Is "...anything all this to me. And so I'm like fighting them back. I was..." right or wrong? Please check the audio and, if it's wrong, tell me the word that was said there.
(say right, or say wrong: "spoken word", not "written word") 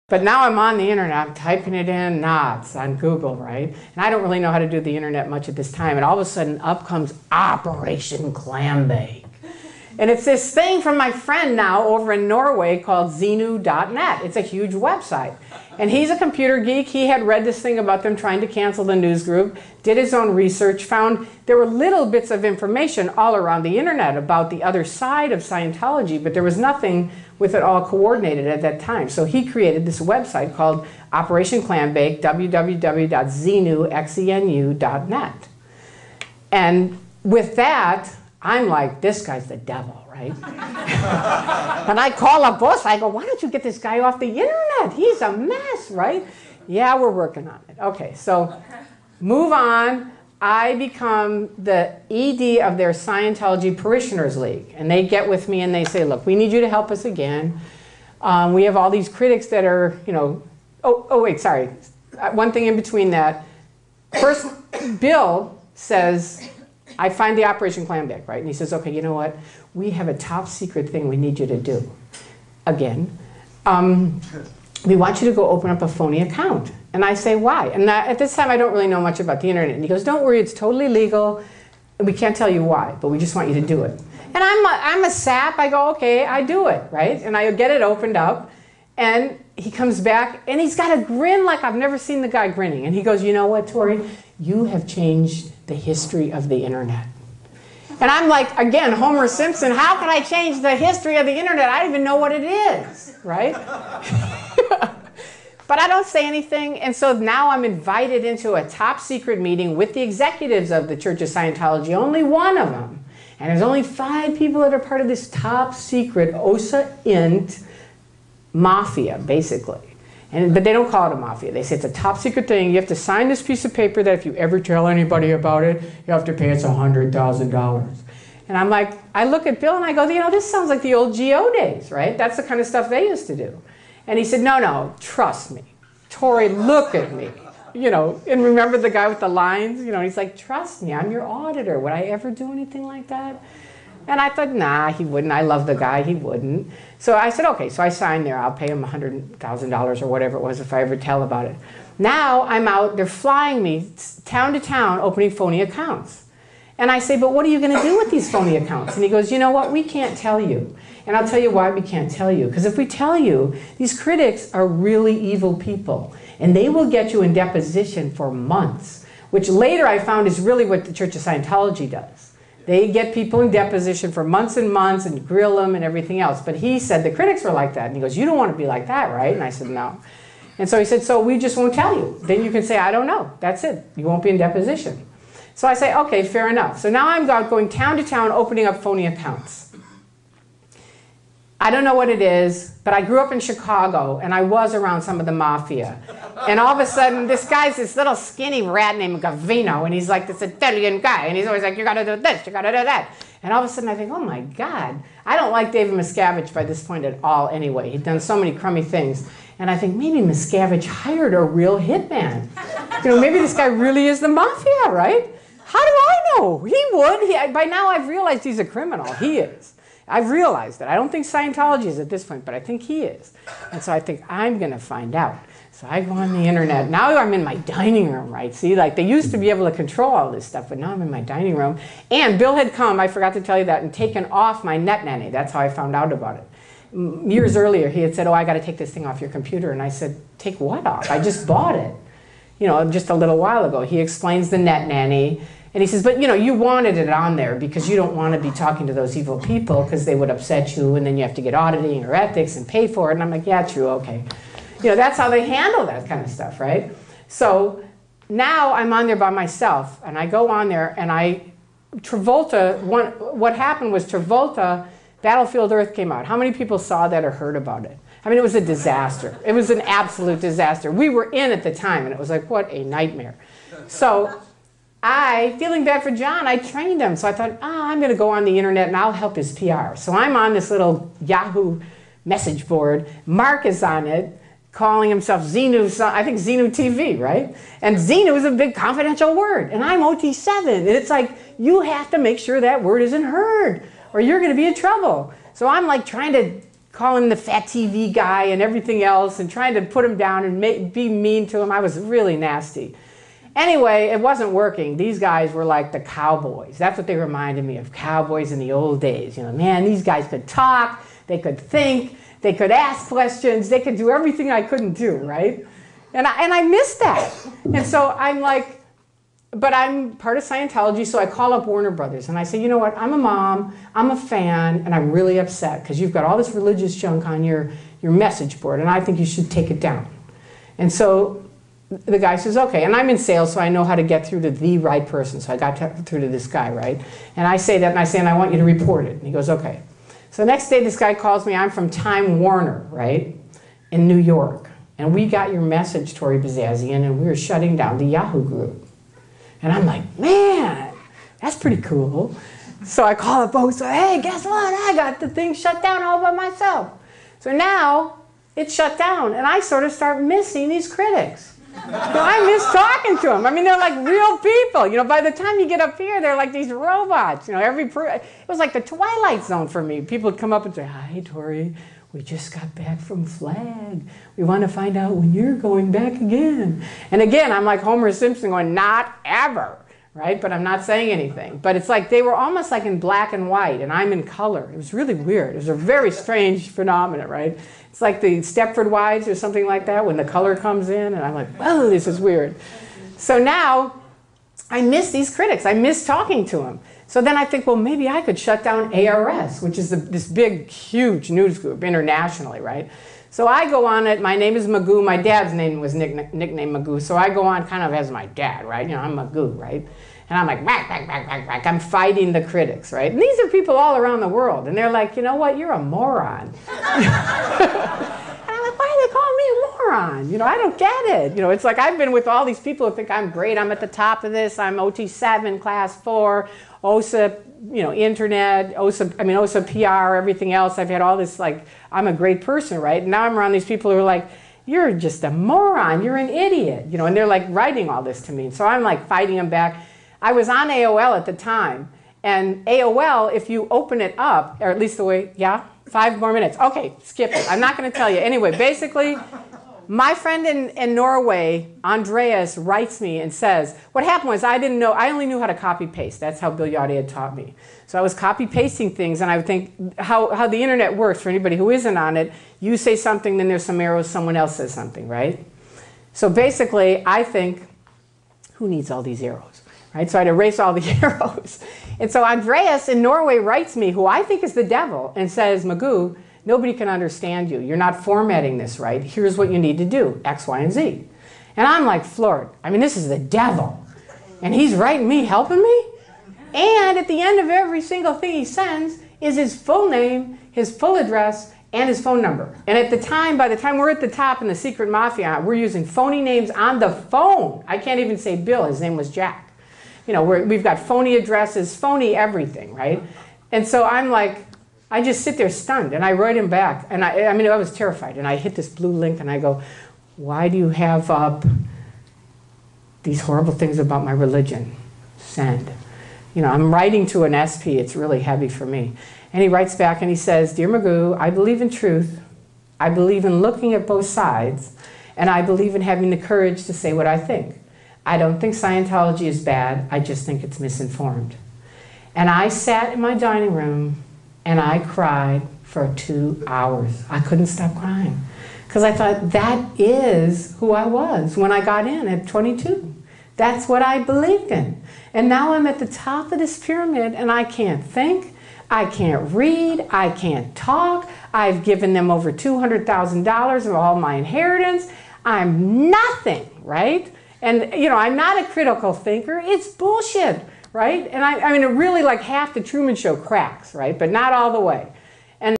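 wrong: "writing", not "anything".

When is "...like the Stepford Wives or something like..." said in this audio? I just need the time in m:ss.
6:28.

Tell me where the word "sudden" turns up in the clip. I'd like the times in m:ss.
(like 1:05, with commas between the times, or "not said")
0:06, 3:16, 3:23.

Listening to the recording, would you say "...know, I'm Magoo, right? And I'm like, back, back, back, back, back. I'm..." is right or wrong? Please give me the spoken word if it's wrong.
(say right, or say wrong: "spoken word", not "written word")
right.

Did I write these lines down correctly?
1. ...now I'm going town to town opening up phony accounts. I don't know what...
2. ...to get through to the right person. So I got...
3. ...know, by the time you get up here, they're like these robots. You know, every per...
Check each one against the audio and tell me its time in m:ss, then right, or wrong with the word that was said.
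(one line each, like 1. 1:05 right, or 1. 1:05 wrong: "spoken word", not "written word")
1. 3:06 right
2. 5:33 right
3. 6:04 right.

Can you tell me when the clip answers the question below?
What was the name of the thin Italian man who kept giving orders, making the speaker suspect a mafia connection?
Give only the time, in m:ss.
3:19.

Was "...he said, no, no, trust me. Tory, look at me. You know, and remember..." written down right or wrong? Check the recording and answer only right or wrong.
right.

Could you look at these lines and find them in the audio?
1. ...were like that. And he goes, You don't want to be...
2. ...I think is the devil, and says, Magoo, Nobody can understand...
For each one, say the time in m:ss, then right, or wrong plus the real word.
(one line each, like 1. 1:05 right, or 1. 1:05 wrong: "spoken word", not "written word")
1. 2:57 right
2. 7:54 right.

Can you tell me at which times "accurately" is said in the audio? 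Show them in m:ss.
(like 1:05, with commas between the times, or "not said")
not said.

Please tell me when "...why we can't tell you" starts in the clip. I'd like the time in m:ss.
2:41.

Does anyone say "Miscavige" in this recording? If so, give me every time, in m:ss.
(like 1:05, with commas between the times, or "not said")
3:25, 3:30.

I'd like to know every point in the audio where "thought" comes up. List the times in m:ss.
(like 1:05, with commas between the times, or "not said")
2:24, 4:37, 8:58.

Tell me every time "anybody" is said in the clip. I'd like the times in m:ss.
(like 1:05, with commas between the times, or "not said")
2:04, 7:41.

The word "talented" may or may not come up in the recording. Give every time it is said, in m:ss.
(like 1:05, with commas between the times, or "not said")
not said.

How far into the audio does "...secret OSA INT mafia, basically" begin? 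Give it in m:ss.
1:55.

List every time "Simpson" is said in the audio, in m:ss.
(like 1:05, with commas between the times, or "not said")
1:39, 6:18.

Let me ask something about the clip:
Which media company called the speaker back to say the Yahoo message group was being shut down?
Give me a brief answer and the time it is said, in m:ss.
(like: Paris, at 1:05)
Time Warner, at 5:41.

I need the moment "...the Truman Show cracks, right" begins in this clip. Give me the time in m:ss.
9:22.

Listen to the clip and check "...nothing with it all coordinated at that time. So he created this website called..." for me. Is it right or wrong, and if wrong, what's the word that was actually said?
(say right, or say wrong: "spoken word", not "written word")
right.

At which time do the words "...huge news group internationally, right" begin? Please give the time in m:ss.
6:40.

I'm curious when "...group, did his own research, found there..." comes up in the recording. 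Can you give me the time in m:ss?
0:19.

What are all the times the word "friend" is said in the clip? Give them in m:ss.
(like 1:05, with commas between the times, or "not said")
0:11, 7:30.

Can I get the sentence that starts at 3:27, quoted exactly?
He'd done so many crummy things.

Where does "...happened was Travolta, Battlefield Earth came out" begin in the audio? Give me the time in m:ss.
4:23.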